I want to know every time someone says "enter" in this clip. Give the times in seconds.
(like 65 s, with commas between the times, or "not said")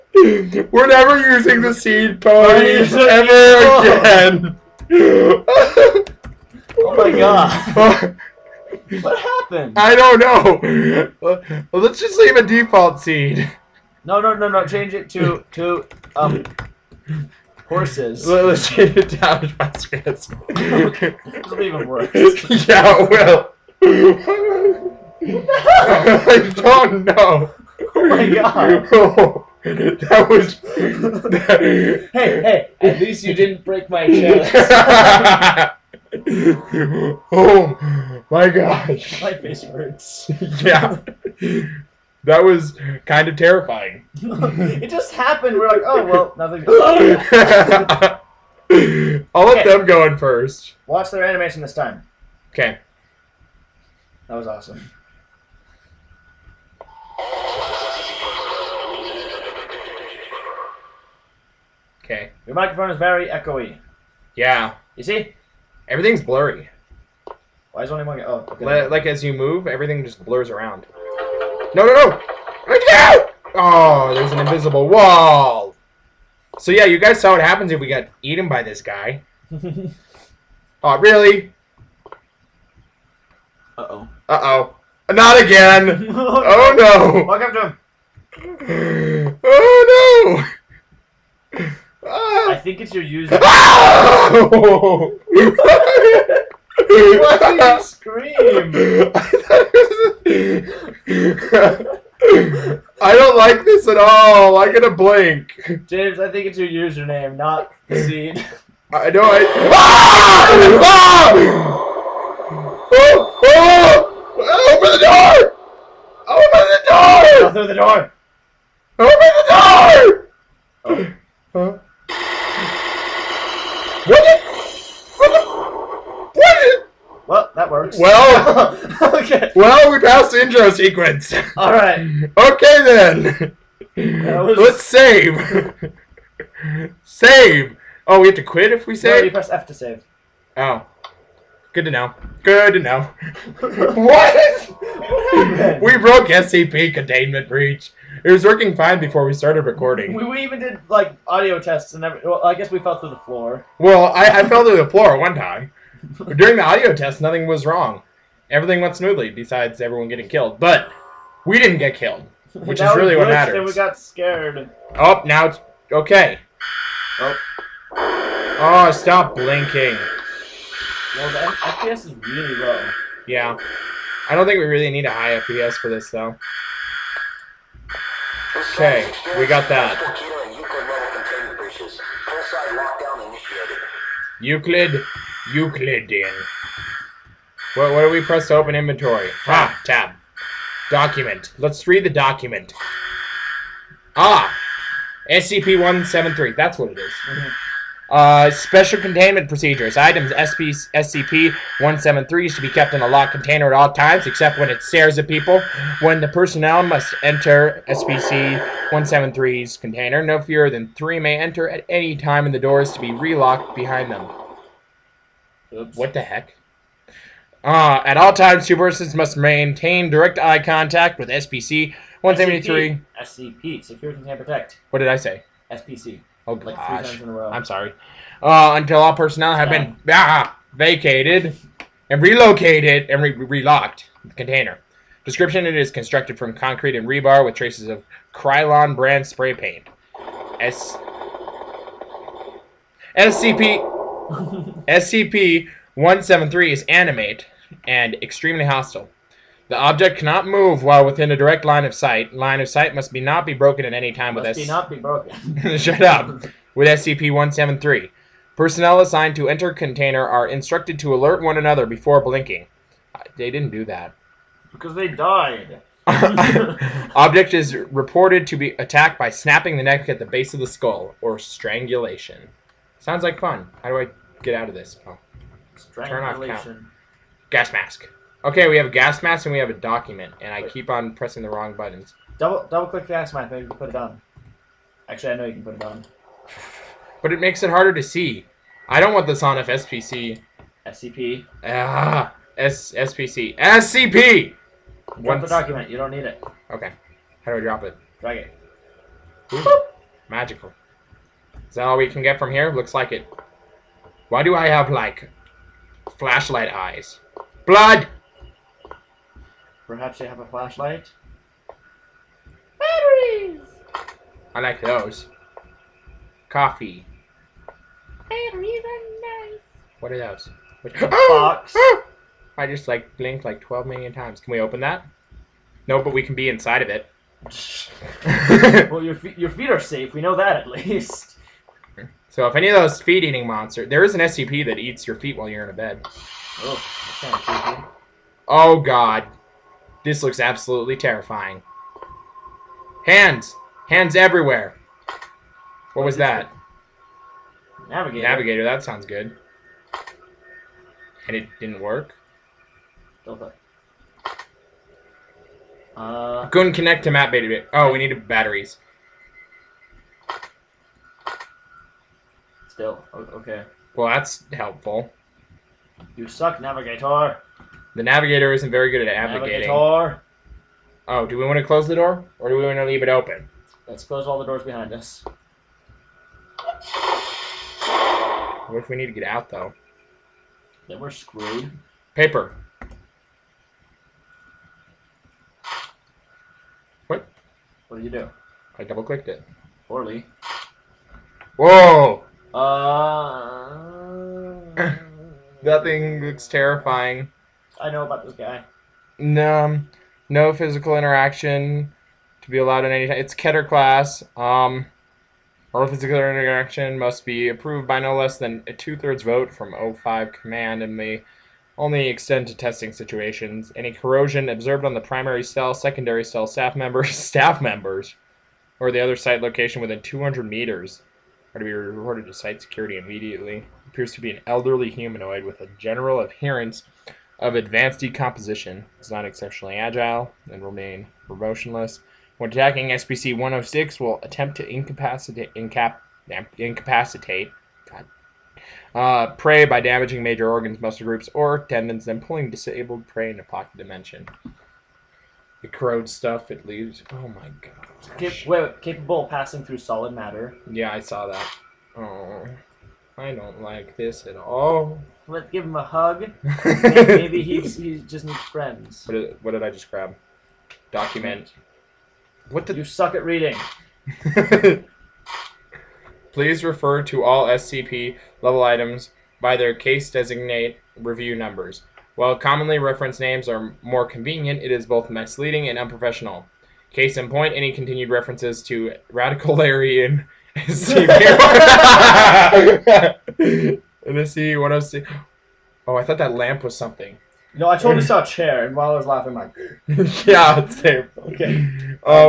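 207 s, 211 s, 259 s.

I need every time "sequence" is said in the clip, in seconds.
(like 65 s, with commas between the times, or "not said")
130 s.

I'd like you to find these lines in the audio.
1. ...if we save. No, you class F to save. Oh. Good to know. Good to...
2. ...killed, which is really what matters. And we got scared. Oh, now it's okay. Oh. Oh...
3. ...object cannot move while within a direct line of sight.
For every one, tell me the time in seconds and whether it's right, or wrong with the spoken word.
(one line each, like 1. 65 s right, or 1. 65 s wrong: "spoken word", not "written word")
1. 138 s wrong: "press", not "class"
2. 161 s right
3. 249 s right.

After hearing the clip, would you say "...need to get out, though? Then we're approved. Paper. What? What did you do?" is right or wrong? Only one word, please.
wrong.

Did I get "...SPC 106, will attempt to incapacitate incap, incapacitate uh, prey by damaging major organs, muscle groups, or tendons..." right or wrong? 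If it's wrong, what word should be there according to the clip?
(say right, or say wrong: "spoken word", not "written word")
right.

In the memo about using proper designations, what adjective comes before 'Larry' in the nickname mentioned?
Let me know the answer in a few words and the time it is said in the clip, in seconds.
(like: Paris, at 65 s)
Radical, at 479 s.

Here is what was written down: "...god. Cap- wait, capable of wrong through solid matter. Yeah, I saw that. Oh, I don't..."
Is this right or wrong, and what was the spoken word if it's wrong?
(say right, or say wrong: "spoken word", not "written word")
wrong: "passing", not "wrong".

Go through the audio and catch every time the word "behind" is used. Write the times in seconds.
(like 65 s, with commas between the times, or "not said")
213 s, 374 s.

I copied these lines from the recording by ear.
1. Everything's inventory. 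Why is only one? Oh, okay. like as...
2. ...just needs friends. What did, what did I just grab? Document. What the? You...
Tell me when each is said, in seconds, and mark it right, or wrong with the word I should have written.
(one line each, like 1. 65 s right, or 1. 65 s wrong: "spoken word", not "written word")
1. 65 s wrong: "blurry", not "inventory"
2. 457 s right.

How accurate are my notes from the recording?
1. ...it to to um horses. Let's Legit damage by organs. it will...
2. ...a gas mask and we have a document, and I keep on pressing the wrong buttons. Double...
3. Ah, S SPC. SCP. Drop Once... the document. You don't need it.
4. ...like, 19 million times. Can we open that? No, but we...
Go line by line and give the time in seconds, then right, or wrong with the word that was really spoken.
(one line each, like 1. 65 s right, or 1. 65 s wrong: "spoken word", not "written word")
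1. 14 s wrong: "scans", not "organs"
2. 278 s right
3. 291 s right
4. 323 s wrong: "12", not "19".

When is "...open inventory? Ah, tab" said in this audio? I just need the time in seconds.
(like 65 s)
188 s.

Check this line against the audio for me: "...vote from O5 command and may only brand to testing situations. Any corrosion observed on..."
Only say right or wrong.
wrong.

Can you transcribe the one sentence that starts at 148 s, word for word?
It was working fine before we started recording.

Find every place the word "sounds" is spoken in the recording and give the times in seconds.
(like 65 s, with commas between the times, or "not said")
273 s, 348 s.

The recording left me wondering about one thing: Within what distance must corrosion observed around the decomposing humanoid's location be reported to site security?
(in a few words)
200 meters.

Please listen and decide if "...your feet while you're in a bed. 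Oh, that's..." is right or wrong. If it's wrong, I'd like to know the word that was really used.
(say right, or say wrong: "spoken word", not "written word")
right.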